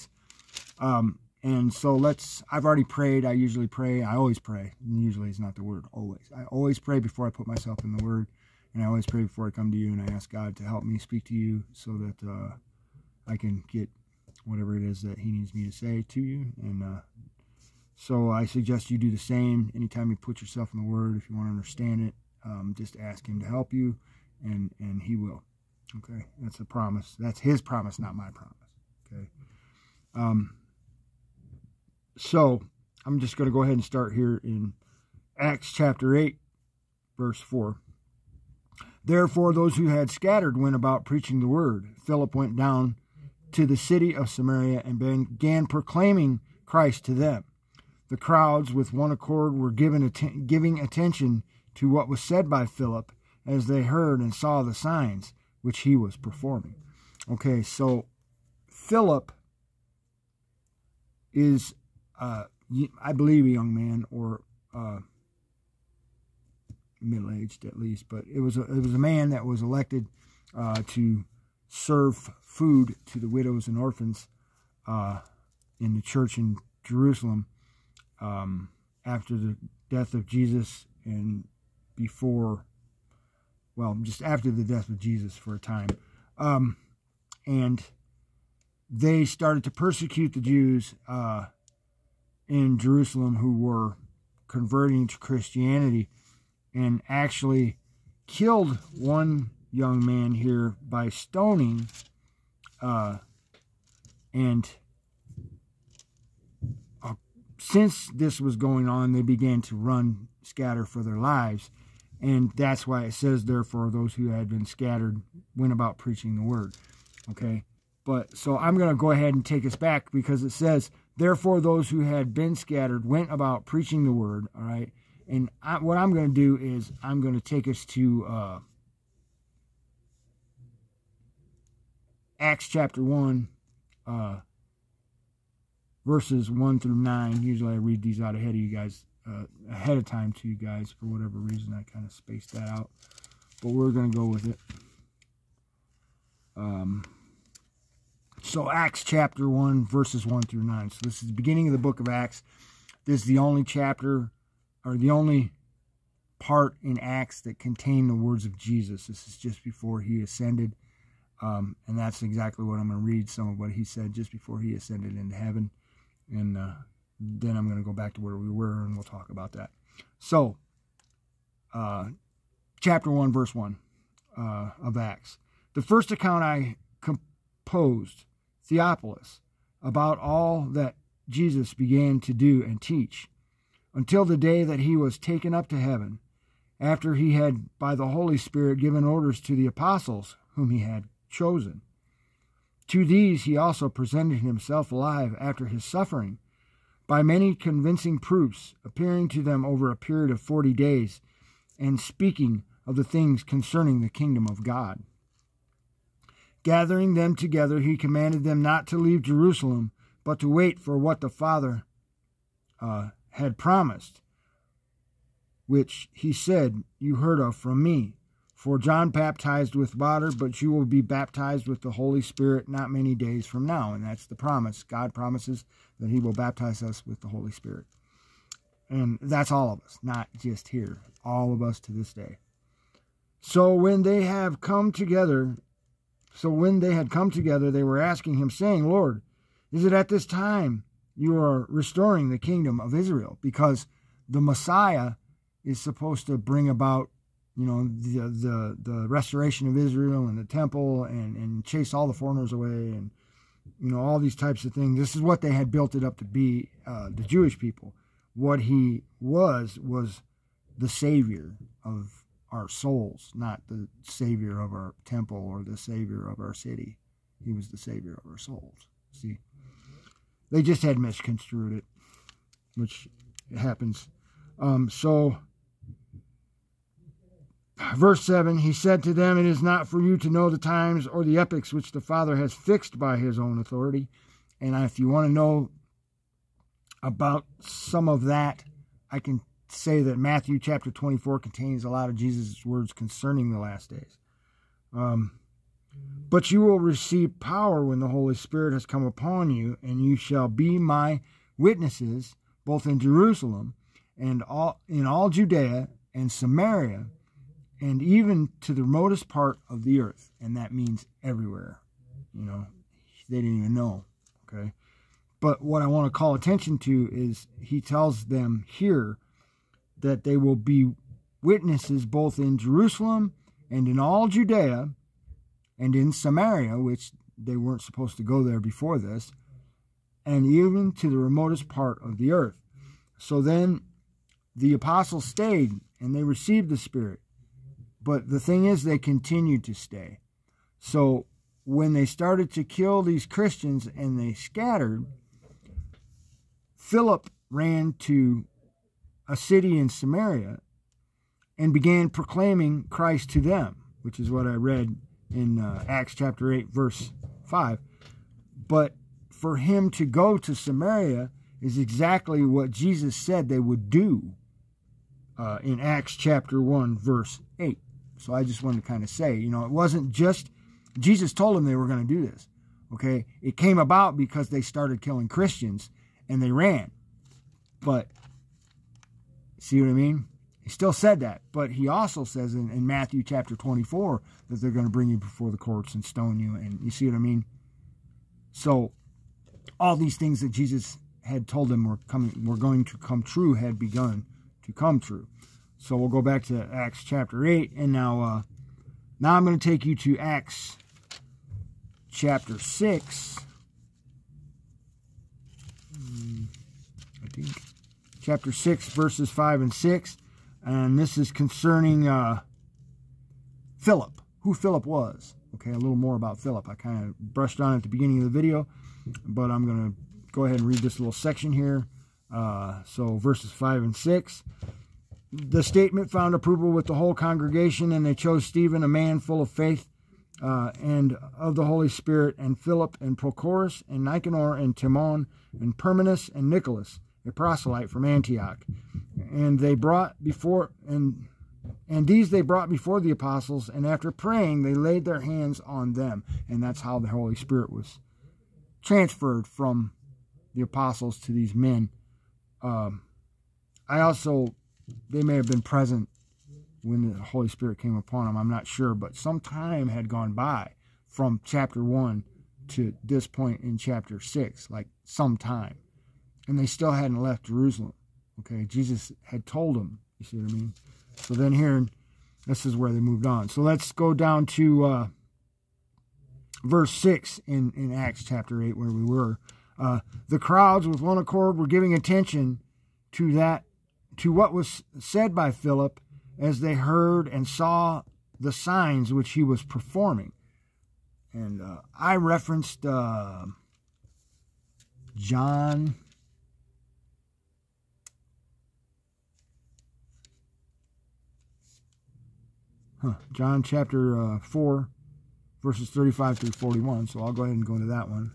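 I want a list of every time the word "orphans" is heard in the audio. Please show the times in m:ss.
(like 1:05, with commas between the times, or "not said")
1:13.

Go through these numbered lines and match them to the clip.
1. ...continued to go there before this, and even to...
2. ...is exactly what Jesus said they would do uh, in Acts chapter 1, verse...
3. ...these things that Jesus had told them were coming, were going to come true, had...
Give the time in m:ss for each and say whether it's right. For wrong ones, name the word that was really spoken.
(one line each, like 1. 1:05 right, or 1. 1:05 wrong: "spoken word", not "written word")
1. 5:27 wrong: "supposed", not "continued"
2. 6:01 right
3. 6:29 right.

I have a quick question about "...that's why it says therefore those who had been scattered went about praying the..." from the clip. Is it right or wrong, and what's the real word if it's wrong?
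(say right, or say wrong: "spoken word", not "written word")
wrong: "preaching", not "praying".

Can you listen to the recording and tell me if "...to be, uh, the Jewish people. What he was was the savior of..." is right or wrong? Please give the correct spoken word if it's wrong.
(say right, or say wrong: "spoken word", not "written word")
right.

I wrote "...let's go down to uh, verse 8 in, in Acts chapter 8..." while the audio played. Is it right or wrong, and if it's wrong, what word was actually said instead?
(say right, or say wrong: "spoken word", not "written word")
wrong: "6", not "8".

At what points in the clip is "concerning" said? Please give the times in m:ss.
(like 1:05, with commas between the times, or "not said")
3:23, 4:52, 6:51.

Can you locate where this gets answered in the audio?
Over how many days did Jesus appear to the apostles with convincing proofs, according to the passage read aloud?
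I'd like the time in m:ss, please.
3:20.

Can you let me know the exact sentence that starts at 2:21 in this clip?
For whatever reason, I kind of spaced that out.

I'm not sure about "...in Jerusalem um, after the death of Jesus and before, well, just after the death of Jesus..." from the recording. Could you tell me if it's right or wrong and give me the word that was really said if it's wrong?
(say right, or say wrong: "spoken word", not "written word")
right.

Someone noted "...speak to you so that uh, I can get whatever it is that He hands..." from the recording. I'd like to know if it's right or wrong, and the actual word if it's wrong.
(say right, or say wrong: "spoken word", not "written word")
wrong: "needs", not "hands".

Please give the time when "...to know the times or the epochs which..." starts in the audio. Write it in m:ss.
4:40.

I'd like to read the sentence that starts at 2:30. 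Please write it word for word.
So this is the beginning of the book of Acts.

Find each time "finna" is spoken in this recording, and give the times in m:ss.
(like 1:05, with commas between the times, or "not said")
not said.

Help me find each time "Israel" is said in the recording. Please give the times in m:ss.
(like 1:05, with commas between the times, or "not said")
4:02, 4:09.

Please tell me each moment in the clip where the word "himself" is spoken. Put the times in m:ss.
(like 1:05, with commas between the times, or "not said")
3:14.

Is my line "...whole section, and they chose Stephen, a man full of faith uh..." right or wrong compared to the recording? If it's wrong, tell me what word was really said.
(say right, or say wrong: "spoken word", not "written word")
wrong: "congregation", not "section".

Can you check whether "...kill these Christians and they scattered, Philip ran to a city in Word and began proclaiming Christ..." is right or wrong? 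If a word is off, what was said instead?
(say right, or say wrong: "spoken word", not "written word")
wrong: "Samaria", not "Word".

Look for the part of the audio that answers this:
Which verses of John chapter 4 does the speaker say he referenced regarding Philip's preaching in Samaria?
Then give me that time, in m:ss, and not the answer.
8:25.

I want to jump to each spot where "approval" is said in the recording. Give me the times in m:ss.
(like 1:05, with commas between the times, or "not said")
7:06.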